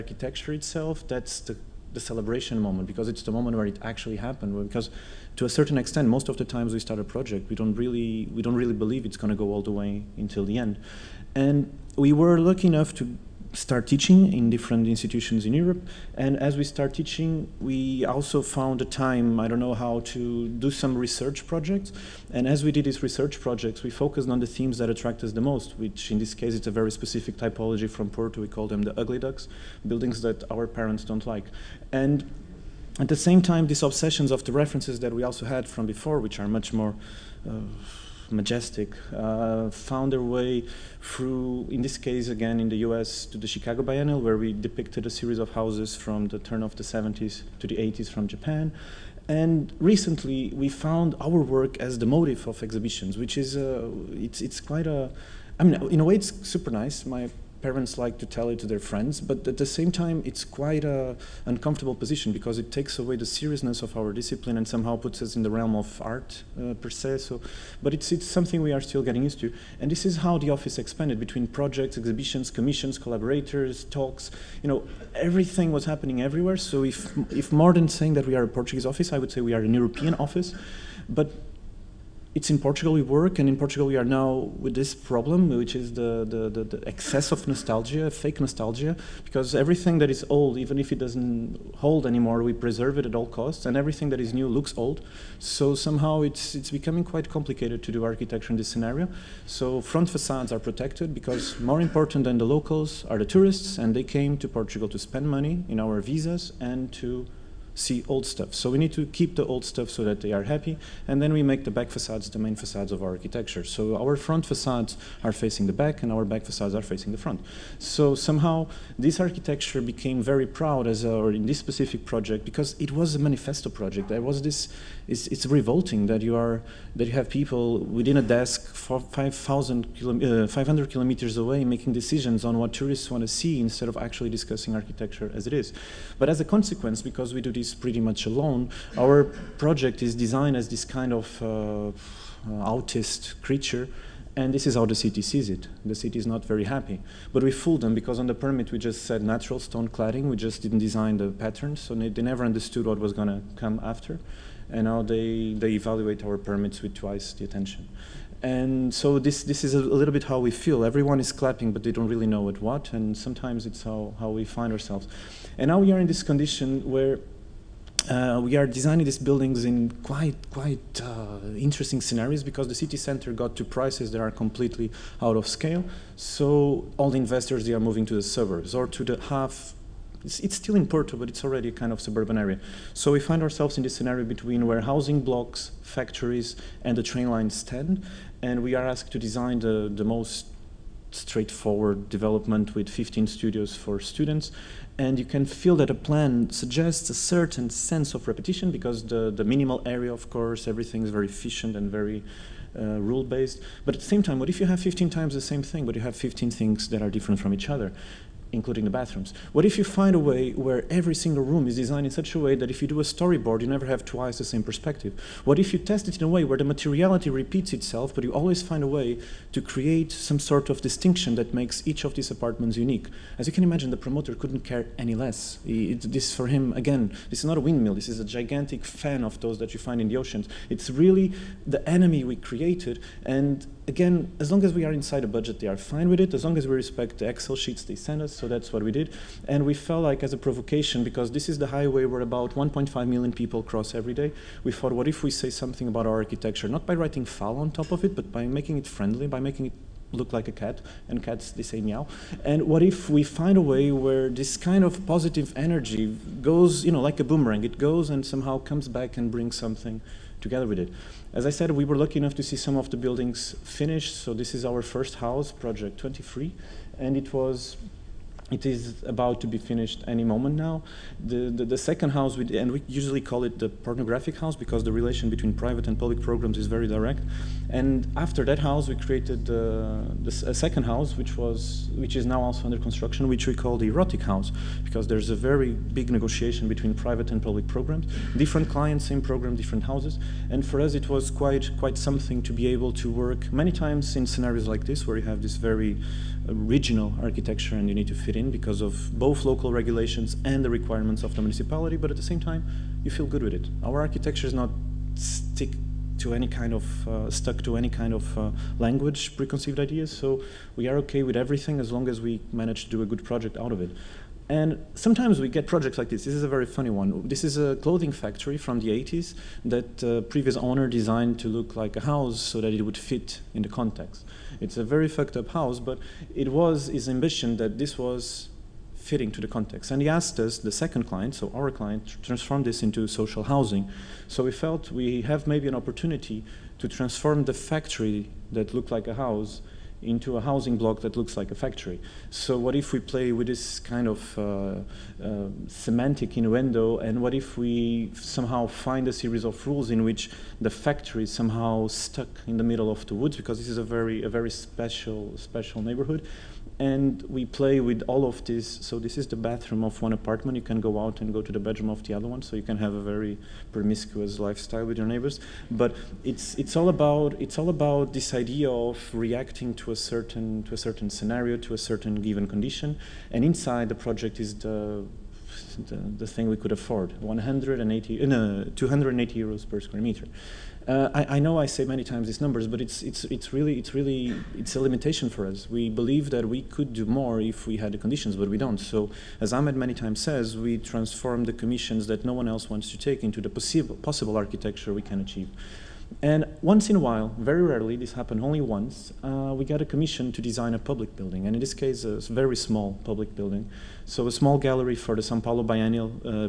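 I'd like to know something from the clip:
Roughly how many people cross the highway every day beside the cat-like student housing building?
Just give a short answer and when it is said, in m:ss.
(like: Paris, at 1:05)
1.5 million, at 4:02.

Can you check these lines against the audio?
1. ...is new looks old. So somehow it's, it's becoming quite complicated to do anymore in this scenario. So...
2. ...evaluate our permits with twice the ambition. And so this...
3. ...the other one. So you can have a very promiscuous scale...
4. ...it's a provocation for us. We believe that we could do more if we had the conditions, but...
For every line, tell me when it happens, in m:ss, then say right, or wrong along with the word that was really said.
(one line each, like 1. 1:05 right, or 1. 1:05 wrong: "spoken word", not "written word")
1. 1:34 wrong: "architecture", not "anymore"
2. 2:35 wrong: "attention", not "ambition"
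3. 6:02 wrong: "lifestyle", not "scale"
4. 6:24 wrong: "limitation", not "provocation".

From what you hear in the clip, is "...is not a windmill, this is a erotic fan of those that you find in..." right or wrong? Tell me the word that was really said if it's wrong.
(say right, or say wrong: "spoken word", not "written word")
wrong: "gigantic", not "erotic".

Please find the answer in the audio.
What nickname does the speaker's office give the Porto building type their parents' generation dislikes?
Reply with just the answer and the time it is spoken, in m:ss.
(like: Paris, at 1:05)
the ugly ducks, at 0:28.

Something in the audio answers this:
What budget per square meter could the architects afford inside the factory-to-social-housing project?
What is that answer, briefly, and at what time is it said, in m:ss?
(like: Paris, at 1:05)
280 euros, at 6:18.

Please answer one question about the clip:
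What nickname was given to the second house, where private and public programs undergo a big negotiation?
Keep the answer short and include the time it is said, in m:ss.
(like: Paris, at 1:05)
the erotic house, at 4:43.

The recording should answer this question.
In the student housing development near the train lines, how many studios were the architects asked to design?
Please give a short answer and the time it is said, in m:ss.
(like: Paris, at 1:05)
15, at 3:12.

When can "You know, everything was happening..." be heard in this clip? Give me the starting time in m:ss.
1:14.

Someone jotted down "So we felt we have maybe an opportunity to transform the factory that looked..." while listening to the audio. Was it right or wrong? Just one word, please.
right.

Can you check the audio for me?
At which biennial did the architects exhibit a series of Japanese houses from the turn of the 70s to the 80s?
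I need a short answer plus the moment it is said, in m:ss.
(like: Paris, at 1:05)
Chicago Biennial, at 0:43.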